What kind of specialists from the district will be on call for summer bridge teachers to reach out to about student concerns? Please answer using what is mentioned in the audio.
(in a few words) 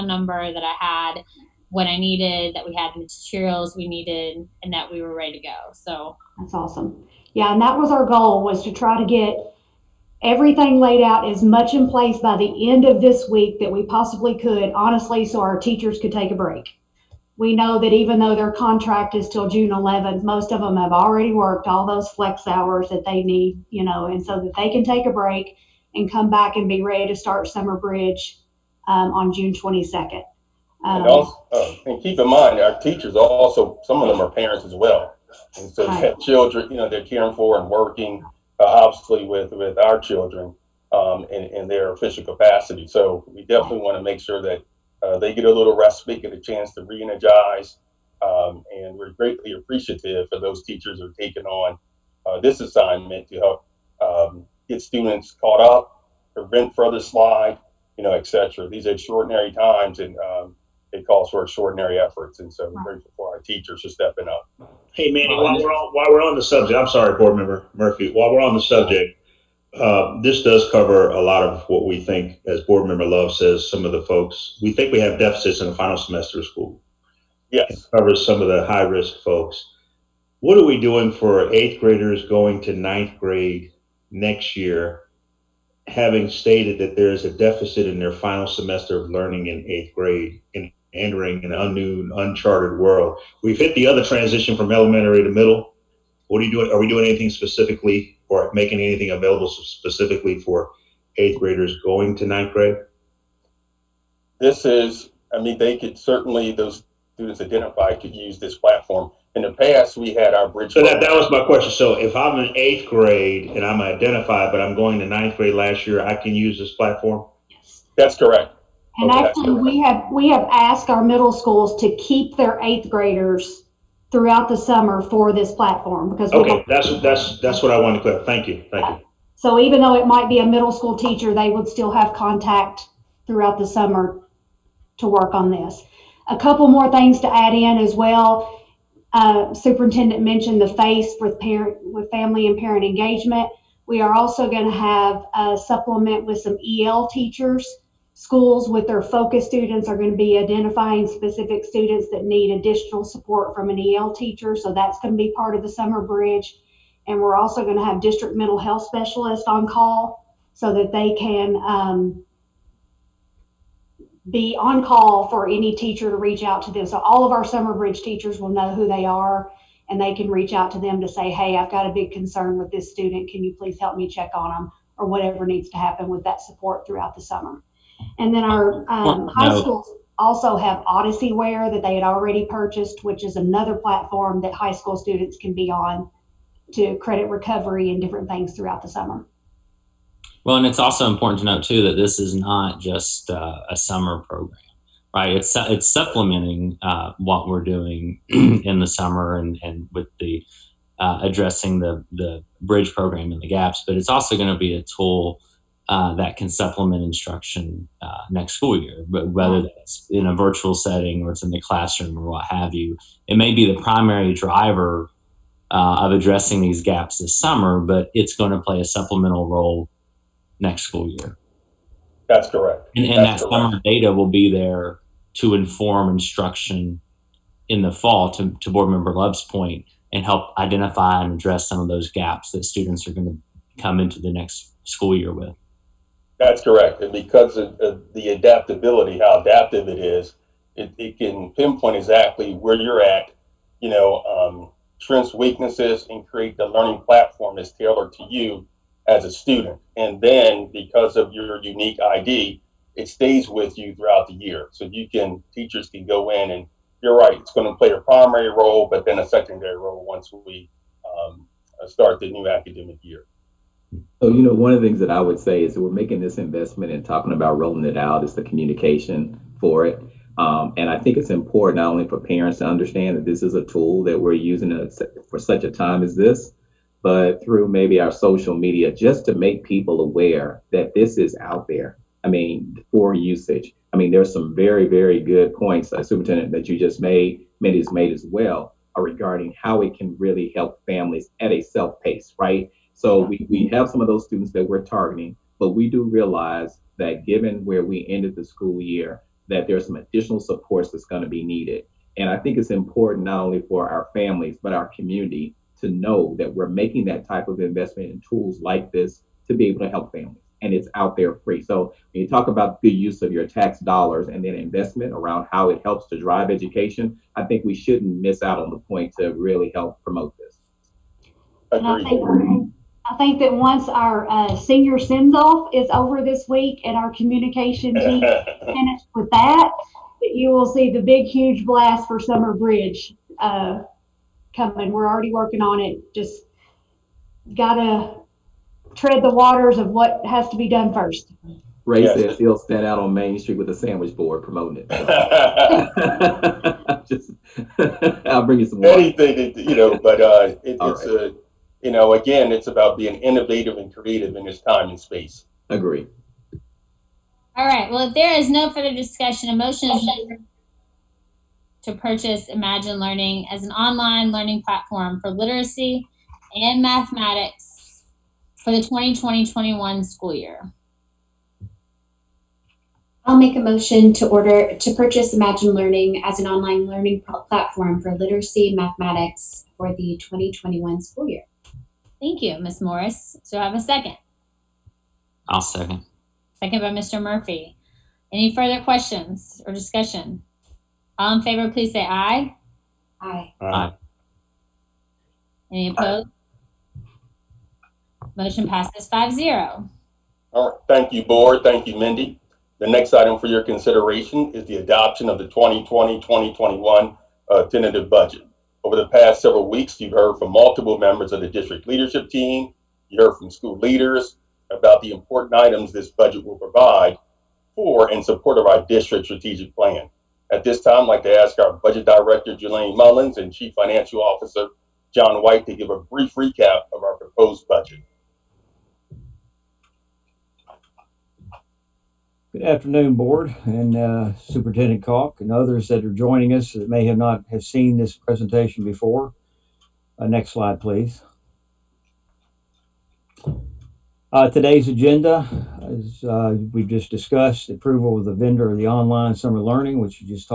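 mental health specialists.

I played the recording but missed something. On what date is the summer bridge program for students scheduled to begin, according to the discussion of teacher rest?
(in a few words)
June 22nd.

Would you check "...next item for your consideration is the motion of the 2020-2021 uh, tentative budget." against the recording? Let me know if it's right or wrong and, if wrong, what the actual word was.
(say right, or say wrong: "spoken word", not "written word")
wrong: "adoption", not "motion".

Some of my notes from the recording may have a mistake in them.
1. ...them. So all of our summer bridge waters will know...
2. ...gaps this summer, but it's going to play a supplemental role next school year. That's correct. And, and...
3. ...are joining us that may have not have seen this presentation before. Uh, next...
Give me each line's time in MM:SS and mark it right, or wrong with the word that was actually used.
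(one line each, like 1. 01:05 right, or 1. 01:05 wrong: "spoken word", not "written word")
1. 02:46 wrong: "teachers", not "waters"
2. 03:36 right
3. 07:16 right.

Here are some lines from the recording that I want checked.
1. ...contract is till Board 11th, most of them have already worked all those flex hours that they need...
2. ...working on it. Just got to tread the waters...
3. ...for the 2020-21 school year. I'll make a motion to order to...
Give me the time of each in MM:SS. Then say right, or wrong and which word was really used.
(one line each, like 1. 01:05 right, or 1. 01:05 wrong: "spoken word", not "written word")
1. 00:18 wrong: "June", not "Board"
2. 05:35 right
3. 06:08 right.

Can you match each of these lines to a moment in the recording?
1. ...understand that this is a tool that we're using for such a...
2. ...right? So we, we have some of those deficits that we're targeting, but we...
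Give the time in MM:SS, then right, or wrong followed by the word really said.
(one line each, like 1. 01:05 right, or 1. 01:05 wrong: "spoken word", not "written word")
1. 04:32 right
2. 04:52 wrong: "students", not "deficits".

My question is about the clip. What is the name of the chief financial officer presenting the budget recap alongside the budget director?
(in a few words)
John White.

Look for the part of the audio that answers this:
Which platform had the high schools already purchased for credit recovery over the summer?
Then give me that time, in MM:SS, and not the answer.
03:00.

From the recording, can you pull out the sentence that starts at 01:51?
So if I'm in eighth grade and I'm identified, but I'm going to ninth grade last year, I can use this platform?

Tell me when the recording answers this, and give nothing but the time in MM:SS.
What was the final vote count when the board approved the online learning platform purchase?
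06:39.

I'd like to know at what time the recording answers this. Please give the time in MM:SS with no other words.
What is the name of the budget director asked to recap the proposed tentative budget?
07:02.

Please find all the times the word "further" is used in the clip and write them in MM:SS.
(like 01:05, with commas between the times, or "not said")
00:56, 05:58, 06:28.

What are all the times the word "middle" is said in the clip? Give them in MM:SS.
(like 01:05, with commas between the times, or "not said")
01:35, 02:01, 02:10.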